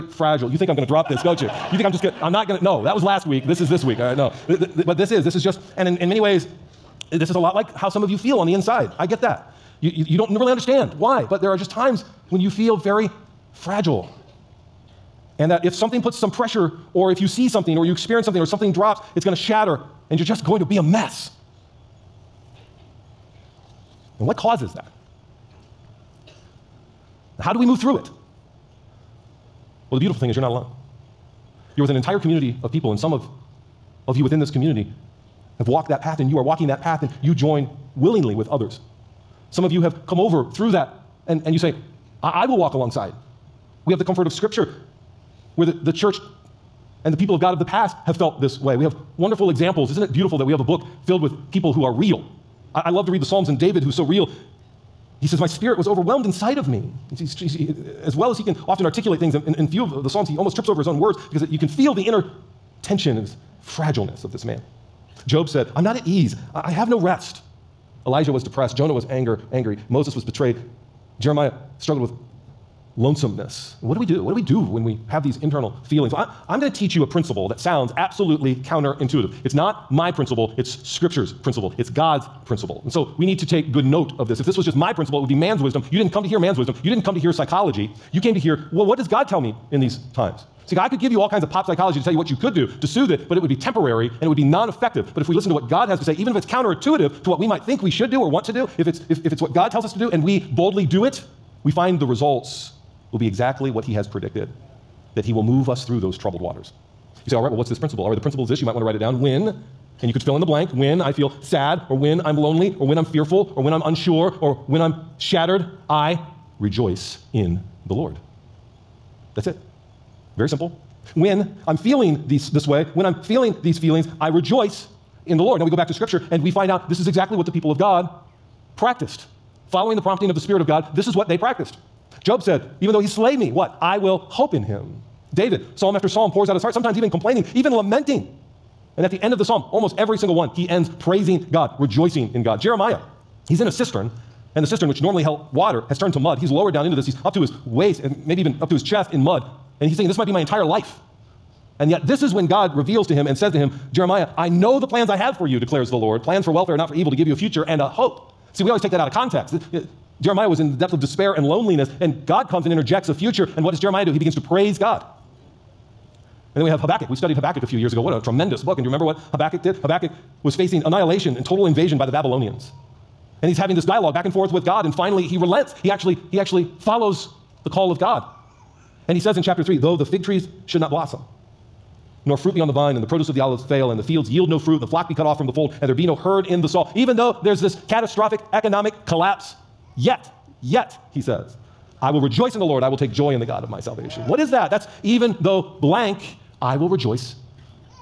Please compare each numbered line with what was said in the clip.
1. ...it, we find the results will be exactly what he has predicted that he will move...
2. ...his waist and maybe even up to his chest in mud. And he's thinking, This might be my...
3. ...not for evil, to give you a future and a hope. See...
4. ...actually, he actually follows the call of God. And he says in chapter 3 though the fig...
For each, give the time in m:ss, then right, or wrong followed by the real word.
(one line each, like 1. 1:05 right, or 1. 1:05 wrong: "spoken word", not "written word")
1. 1:41 right
2. 2:27 right
3. 2:36 right
4. 2:55 right.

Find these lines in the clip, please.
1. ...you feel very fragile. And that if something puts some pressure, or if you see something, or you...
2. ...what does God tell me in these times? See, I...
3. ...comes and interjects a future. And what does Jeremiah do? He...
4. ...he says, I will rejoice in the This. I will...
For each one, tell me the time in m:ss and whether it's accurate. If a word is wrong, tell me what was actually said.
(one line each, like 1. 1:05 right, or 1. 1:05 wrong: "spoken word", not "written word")
1. 0:12 right
2. 1:28 right
3. 2:42 right
4. 3:11 wrong: "Lord", not "This".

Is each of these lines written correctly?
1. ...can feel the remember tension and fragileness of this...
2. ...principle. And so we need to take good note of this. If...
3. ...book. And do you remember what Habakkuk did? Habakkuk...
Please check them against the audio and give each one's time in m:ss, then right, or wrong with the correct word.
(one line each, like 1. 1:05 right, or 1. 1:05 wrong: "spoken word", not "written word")
1. 1:01 wrong: "inner", not "remember"
2. 1:22 right
3. 2:48 right.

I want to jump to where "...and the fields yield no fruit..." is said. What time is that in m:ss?
3:03.